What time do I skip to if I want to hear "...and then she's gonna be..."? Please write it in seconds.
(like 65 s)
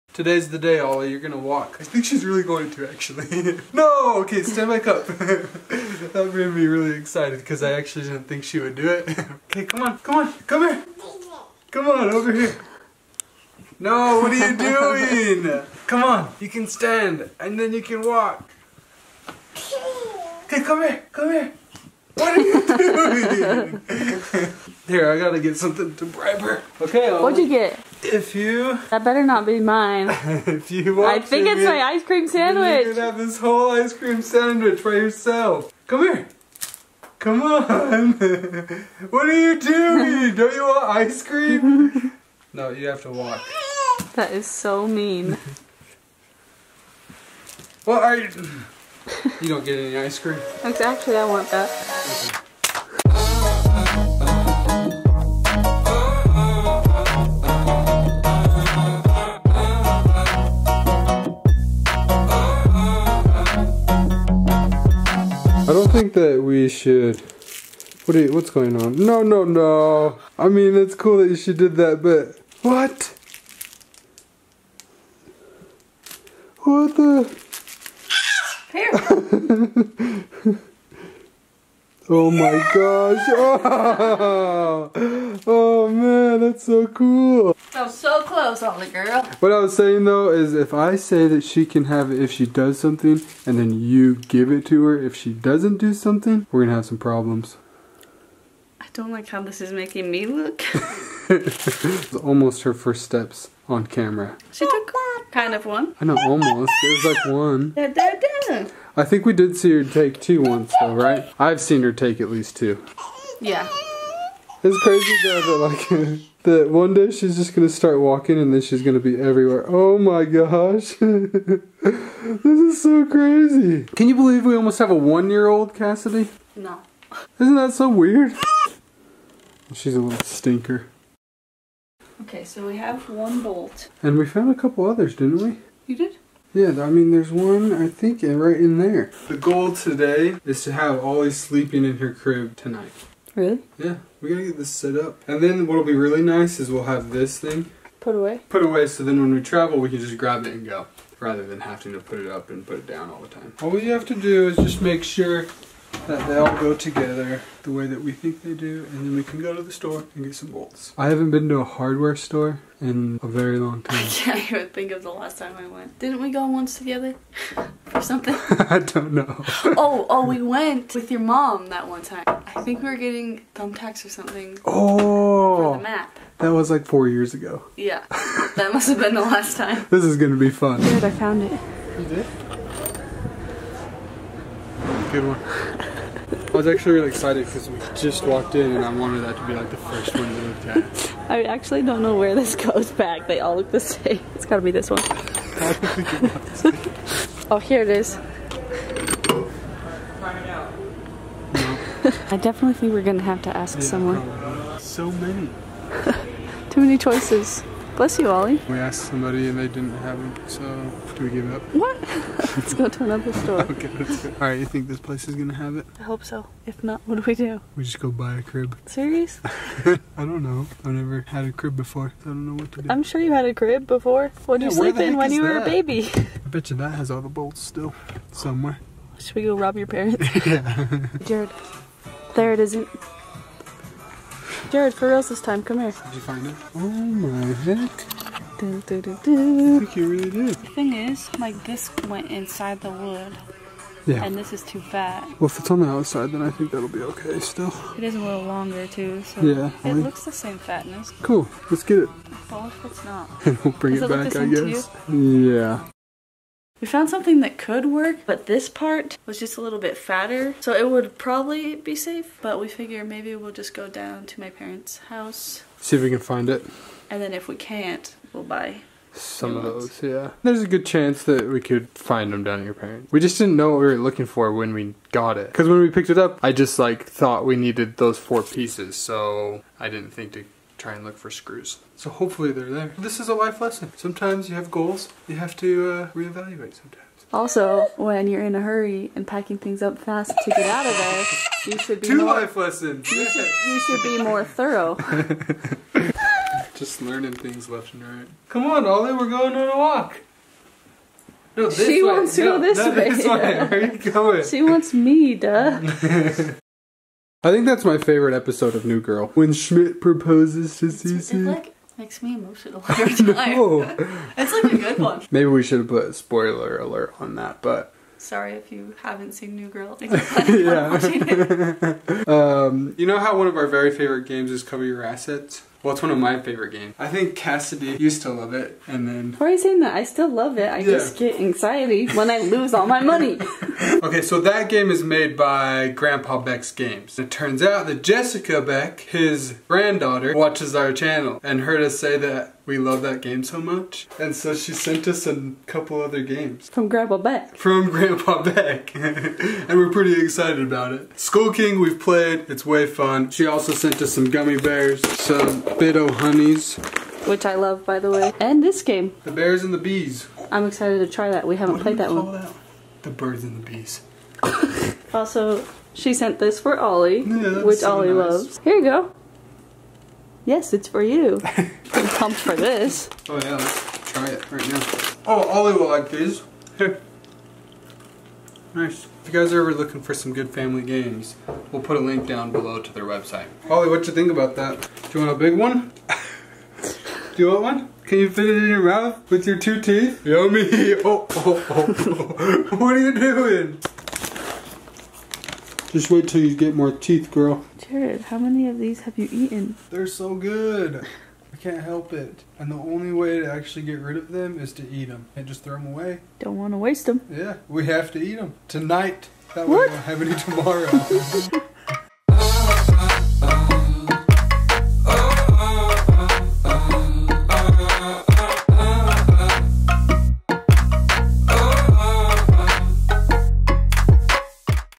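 118 s.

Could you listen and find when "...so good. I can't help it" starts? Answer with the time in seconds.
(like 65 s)
400 s.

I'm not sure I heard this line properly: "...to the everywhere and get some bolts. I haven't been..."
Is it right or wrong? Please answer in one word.
wrong.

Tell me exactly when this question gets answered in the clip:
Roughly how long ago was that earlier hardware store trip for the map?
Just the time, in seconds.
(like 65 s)
176 s.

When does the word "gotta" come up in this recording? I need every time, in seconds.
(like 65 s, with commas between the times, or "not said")
25 s, 144 s, 194 s.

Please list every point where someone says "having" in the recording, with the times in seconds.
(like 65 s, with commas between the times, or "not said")
151 s.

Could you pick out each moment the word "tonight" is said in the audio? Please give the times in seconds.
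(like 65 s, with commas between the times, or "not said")
142 s, 408 s.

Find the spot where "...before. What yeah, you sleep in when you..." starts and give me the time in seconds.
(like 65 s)
223 s.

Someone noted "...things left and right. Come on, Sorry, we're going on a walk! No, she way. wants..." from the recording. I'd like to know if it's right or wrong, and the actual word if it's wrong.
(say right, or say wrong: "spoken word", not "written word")
wrong: "Ollie", not "Sorry".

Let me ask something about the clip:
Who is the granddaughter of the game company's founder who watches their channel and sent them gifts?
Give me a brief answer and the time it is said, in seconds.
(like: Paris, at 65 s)
Jessica Beck, at 338 s.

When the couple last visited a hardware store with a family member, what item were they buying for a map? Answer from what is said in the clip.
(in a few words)
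Thumbtacks.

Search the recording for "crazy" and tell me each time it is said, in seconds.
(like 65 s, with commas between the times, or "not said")
114 s, 123 s.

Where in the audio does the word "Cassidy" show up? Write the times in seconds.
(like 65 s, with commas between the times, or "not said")
125 s, 327 s.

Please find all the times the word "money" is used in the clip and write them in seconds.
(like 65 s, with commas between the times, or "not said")
332 s.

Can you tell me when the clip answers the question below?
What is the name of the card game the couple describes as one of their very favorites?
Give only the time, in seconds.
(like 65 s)
324 s.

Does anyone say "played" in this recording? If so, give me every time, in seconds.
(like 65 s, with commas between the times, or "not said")
351 s, 361 s.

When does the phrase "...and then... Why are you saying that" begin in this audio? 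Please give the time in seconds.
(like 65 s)
328 s.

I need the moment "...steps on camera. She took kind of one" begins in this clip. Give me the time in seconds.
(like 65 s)
103 s.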